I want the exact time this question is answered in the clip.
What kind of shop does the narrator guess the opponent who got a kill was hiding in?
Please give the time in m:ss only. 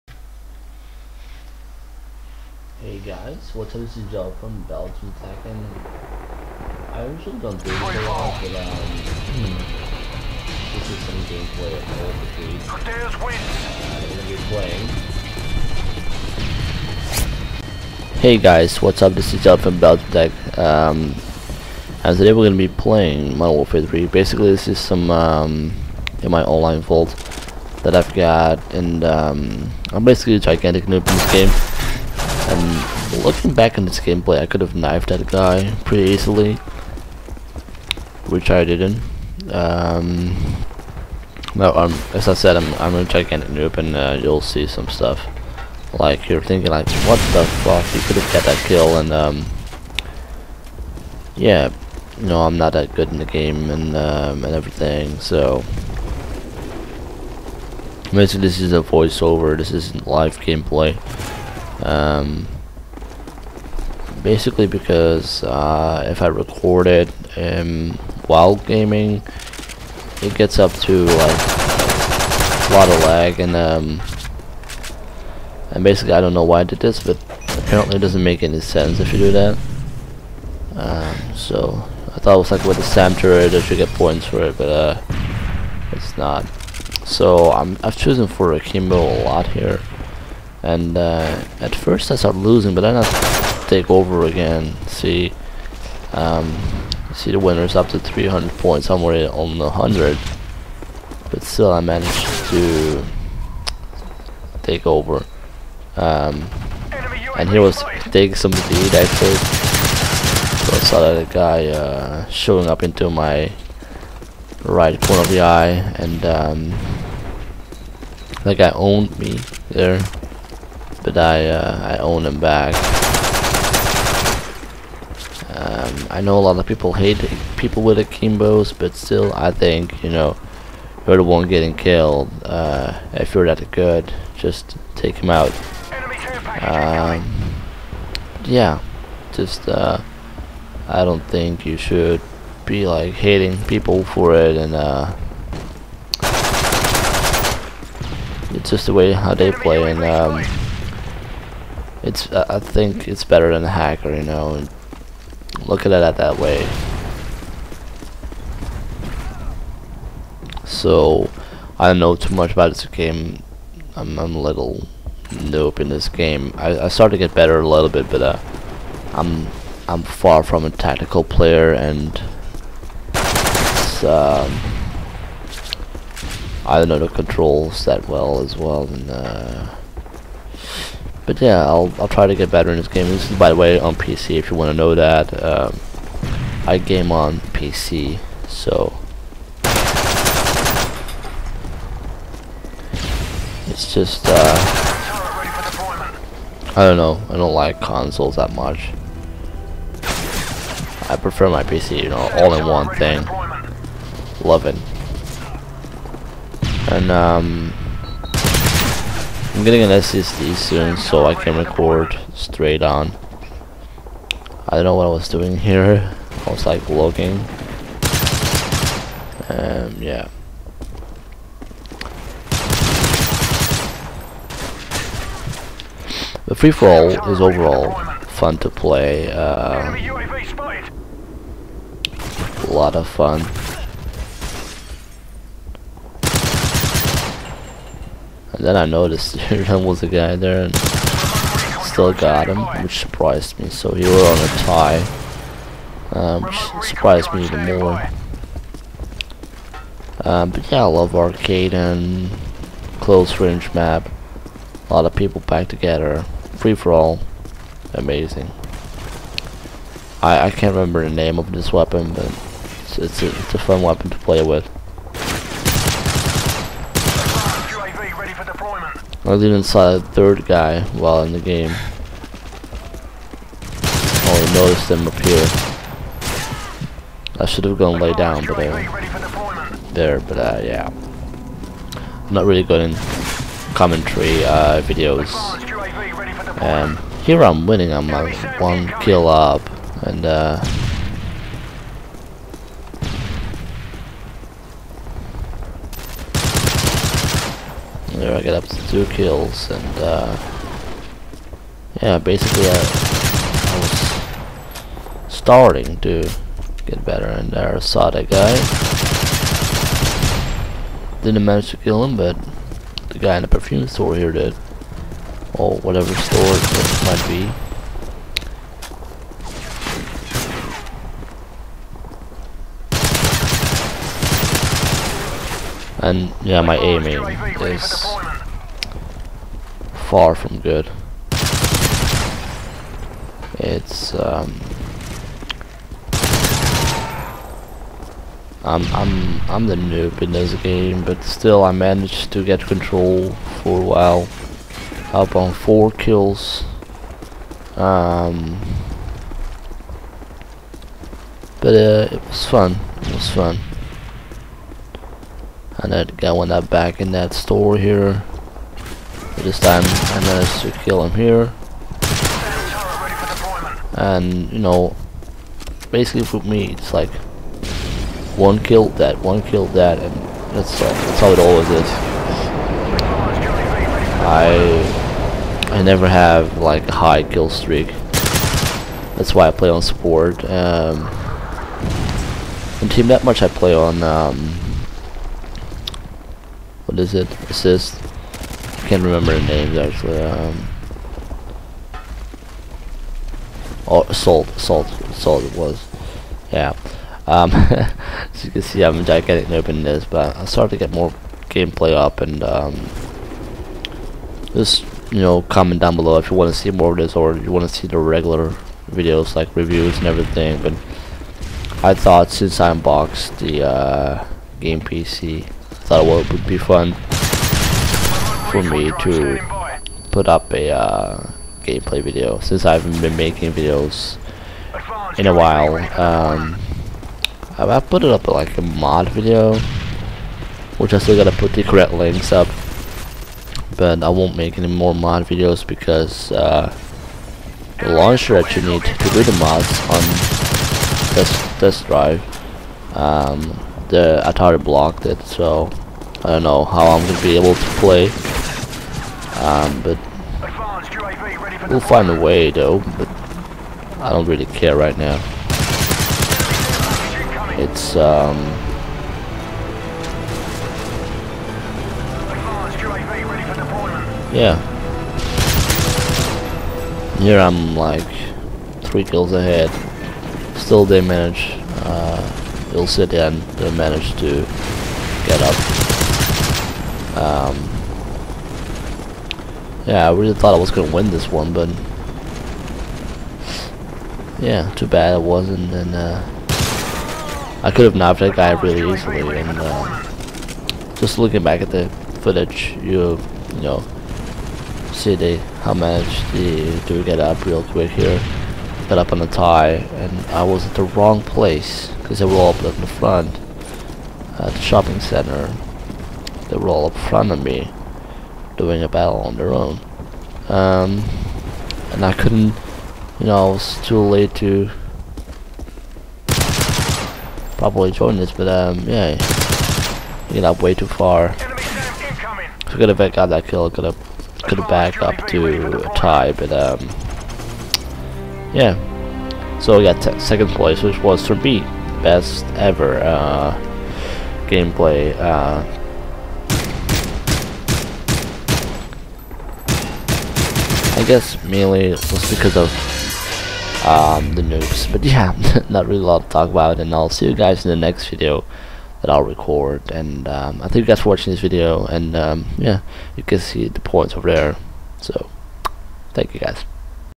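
5:13.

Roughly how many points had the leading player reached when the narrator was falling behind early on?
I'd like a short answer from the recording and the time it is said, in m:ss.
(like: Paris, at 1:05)
300, at 1:37.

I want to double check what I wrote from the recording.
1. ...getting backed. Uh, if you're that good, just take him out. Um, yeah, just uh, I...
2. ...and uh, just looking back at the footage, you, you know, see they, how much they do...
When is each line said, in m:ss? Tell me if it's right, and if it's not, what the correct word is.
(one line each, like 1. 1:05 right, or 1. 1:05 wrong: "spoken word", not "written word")
1. 2:11 wrong: "killed", not "backed"
2. 8:09 right.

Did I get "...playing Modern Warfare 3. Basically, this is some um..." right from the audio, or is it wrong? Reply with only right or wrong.
right.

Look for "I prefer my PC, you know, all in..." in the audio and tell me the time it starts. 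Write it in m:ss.
3:21.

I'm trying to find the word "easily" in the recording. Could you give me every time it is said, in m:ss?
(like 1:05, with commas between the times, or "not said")
0:36, 8:08.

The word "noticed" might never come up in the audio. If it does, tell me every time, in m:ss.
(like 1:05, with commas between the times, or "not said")
3:58, 4:34.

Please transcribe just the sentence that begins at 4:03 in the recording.
So he were on a tie, um, which surprised me even more.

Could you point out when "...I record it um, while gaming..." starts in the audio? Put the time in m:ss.
1:06.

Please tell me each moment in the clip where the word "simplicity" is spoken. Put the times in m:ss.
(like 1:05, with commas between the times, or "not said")
not said.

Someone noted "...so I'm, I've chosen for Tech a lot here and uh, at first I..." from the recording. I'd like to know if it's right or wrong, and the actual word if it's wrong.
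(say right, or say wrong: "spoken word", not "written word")
wrong: "Akimbo", not "Tech".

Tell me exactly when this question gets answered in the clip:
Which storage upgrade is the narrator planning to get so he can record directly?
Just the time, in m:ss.
3:29.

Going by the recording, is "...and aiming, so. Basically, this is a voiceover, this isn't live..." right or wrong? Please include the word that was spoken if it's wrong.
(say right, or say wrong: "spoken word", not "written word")
wrong: "everything", not "aiming".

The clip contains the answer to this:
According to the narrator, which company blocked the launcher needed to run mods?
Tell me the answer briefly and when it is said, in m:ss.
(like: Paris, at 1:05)
Atari, at 7:24.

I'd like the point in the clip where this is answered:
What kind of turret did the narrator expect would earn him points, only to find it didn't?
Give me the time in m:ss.
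1:22.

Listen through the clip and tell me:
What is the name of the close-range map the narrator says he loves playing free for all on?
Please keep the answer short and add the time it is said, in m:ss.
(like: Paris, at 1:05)
Arkaden, at 4:11.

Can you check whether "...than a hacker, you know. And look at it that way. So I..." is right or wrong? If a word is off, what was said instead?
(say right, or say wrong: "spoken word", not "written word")
right.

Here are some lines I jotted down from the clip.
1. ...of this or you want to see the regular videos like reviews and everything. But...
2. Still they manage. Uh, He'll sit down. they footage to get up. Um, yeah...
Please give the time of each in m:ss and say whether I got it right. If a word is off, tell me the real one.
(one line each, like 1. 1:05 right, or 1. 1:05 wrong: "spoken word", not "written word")
1. 6:46 right
2. 7:50 wrong: "manage", not "footage".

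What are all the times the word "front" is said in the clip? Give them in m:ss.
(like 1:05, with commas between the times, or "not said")
8:22, 8:26.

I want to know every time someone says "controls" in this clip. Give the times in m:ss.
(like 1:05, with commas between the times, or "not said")
2:57, 5:42.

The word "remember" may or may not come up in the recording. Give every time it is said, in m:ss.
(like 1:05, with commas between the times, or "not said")
4:20, 6:29.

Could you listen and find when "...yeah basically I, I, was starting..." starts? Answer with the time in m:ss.
5:02.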